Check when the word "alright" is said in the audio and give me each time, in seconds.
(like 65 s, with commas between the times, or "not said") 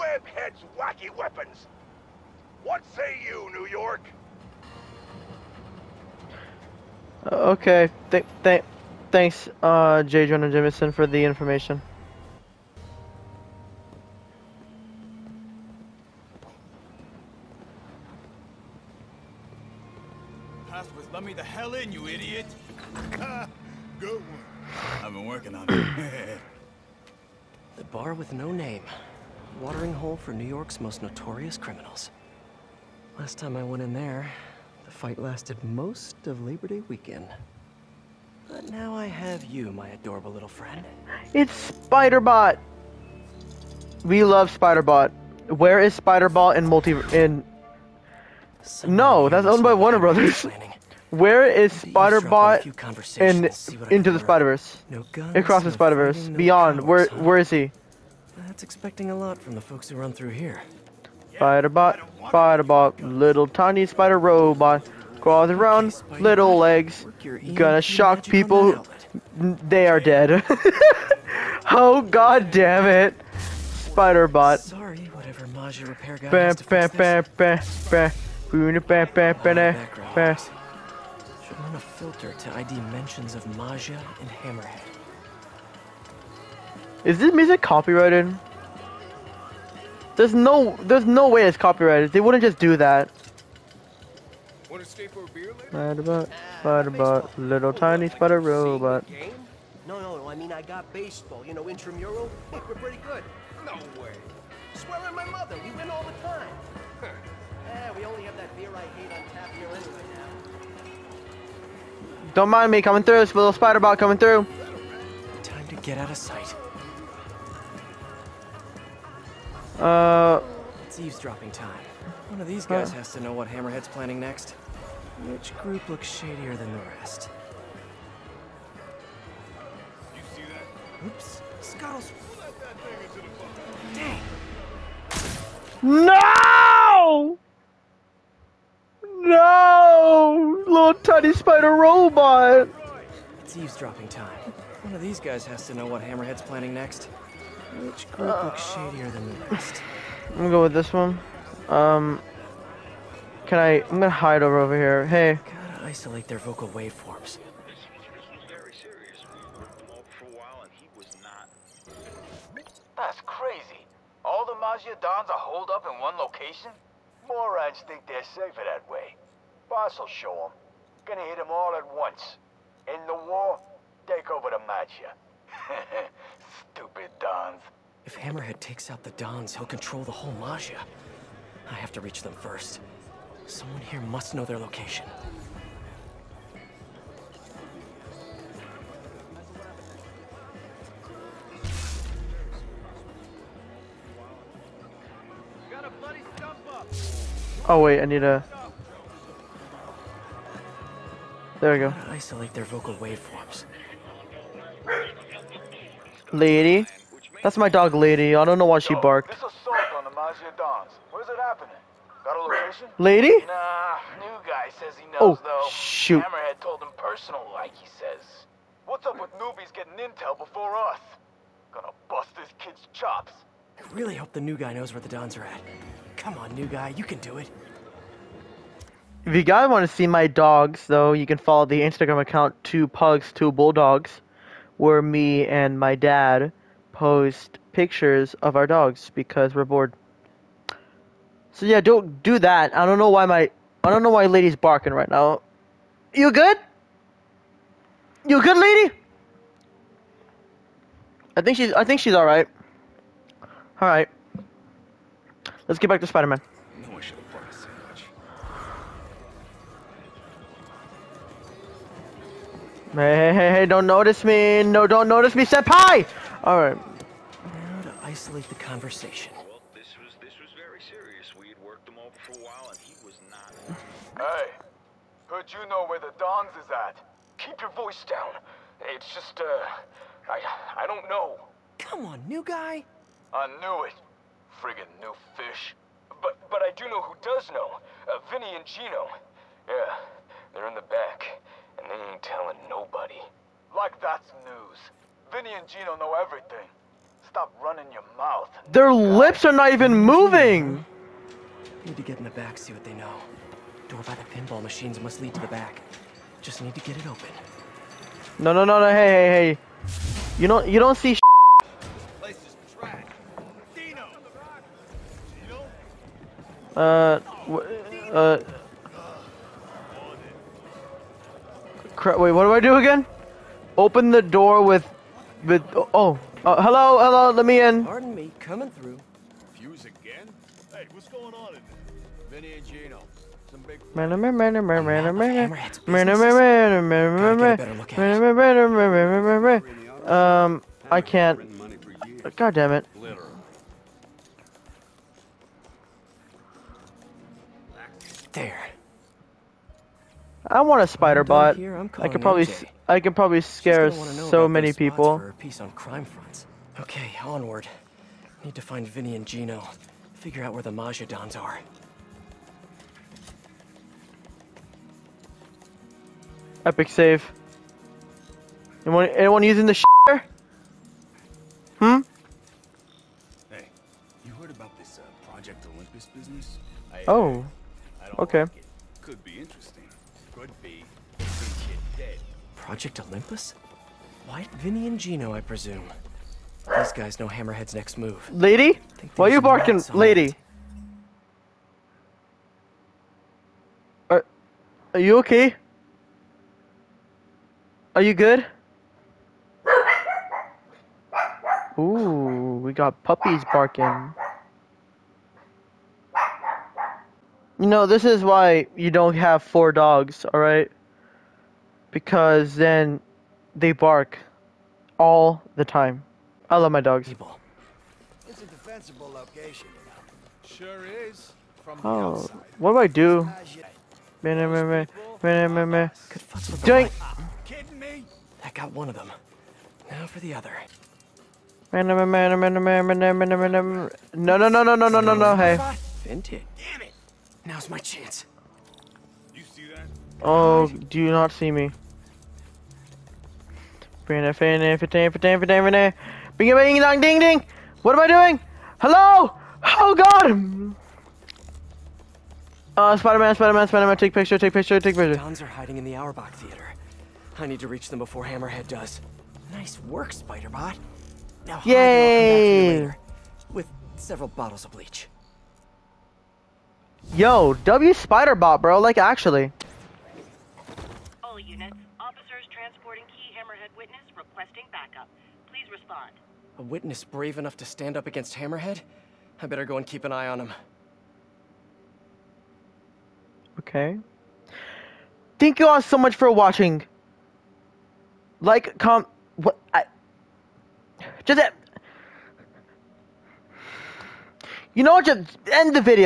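266 s, 410 s.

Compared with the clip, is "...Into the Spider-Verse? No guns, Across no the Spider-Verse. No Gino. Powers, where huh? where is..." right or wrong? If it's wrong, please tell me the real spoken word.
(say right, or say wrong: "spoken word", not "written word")
wrong: "Beyond", not "Gino".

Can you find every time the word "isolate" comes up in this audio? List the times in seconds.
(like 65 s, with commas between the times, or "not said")
155 s, 202 s, 268 s.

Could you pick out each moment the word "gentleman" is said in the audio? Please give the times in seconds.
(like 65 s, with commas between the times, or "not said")
not said.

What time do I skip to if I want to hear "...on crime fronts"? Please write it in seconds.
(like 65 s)
355 s.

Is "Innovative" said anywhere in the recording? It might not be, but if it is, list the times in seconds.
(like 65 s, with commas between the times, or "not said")
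not said.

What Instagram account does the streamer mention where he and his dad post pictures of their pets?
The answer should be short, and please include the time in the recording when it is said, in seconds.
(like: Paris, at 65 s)
Two Pugs Two Bulldogs, at 232 s.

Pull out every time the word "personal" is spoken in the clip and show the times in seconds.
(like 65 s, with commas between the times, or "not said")
216 s.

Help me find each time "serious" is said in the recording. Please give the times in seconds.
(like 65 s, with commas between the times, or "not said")
270 s.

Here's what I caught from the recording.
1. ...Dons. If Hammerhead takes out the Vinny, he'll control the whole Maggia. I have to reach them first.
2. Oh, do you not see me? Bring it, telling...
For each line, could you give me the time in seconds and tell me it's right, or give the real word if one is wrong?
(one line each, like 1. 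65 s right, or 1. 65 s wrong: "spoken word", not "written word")
1. 177 s wrong: "Dons", not "Vinny"
2. 440 s wrong: "bring", not "telling".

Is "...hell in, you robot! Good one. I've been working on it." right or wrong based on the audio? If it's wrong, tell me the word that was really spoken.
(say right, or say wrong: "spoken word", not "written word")
wrong: "idiot", not "robot".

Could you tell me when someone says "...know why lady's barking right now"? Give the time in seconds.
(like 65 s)
244 s.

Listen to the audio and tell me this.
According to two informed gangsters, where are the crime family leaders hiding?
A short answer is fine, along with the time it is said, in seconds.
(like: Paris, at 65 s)
Auerbach Theater, at 455 s.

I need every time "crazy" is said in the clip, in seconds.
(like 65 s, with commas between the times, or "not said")
163 s.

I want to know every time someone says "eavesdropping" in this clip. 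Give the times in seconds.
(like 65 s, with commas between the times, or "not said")
120 s, 143 s.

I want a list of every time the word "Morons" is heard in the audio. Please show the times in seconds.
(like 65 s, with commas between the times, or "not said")
167 s.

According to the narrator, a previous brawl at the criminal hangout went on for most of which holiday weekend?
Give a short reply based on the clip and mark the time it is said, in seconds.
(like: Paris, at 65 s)
Labor Day, at 36 s.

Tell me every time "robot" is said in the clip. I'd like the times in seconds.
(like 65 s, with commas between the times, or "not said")
64 s, 98 s, 141 s.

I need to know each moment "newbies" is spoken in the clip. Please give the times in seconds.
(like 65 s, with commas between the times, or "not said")
219 s.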